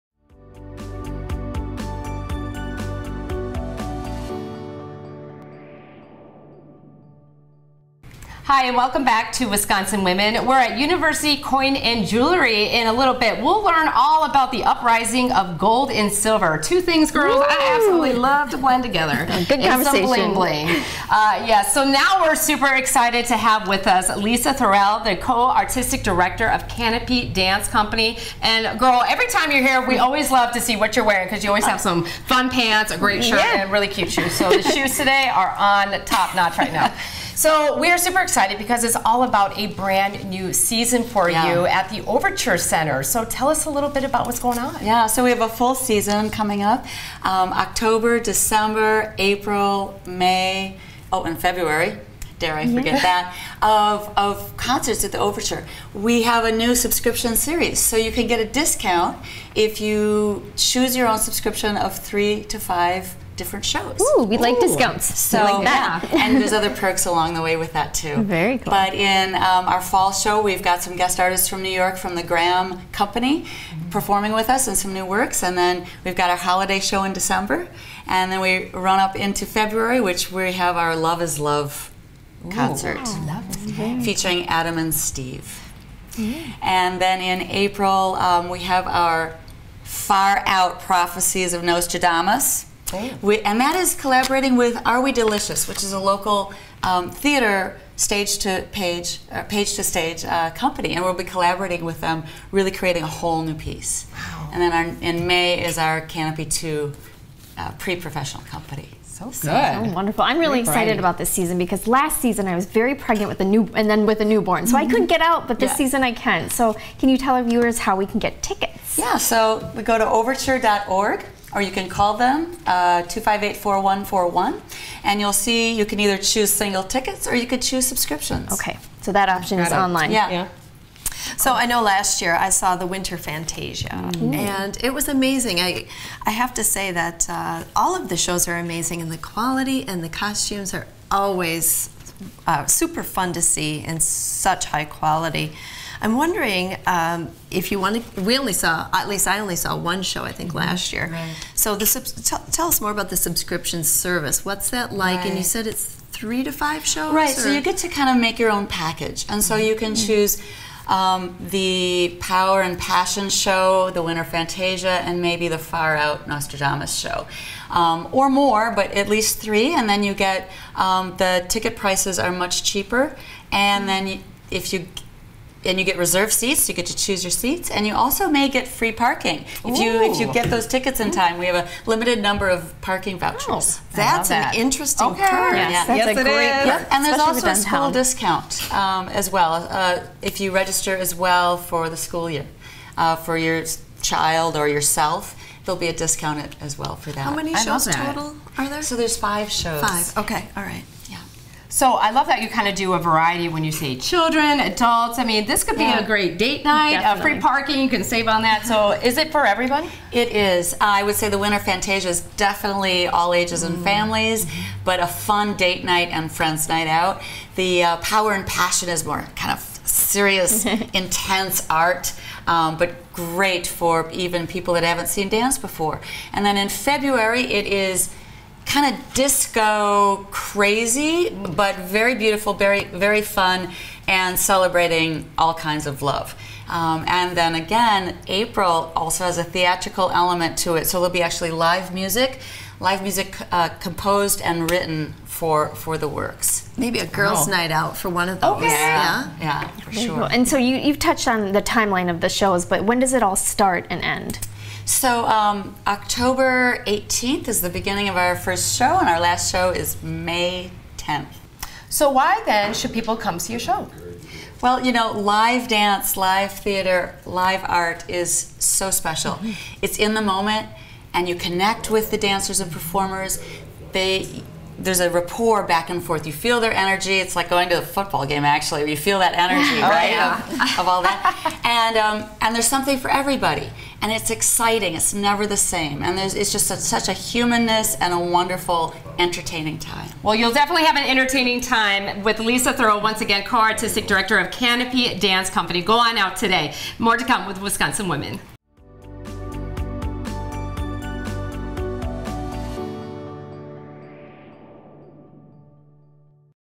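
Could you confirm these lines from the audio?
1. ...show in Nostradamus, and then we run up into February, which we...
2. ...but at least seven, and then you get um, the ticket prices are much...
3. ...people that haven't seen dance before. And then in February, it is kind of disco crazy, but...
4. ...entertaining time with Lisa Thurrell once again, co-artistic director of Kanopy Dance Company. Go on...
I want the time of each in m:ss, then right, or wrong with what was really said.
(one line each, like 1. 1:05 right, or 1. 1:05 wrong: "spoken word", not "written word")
1. 1:16 wrong: "December", not "Nostradamus"
2. 2:48 wrong: "three", not "seven"
3. 3:44 right
4. 4:51 right.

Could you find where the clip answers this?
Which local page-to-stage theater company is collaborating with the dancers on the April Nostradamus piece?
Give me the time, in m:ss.
1:34.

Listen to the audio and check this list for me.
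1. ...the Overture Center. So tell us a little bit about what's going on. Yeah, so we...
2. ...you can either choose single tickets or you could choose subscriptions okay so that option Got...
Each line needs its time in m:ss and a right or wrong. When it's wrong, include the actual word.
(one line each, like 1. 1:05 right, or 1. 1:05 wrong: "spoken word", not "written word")
1. 0:41 right
2. 2:05 right.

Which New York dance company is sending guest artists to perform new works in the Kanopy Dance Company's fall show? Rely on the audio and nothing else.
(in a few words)
Graham Company.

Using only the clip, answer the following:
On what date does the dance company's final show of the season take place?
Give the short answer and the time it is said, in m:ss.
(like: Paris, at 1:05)
May 10th, at 4:20.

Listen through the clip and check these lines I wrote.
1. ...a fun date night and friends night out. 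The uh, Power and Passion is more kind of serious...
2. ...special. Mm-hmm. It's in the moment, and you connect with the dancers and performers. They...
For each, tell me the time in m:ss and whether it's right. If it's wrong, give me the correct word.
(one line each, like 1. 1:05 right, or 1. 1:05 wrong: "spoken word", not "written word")
1. 3:34 right
2. 4:28 right.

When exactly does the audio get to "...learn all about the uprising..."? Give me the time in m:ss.
0:13.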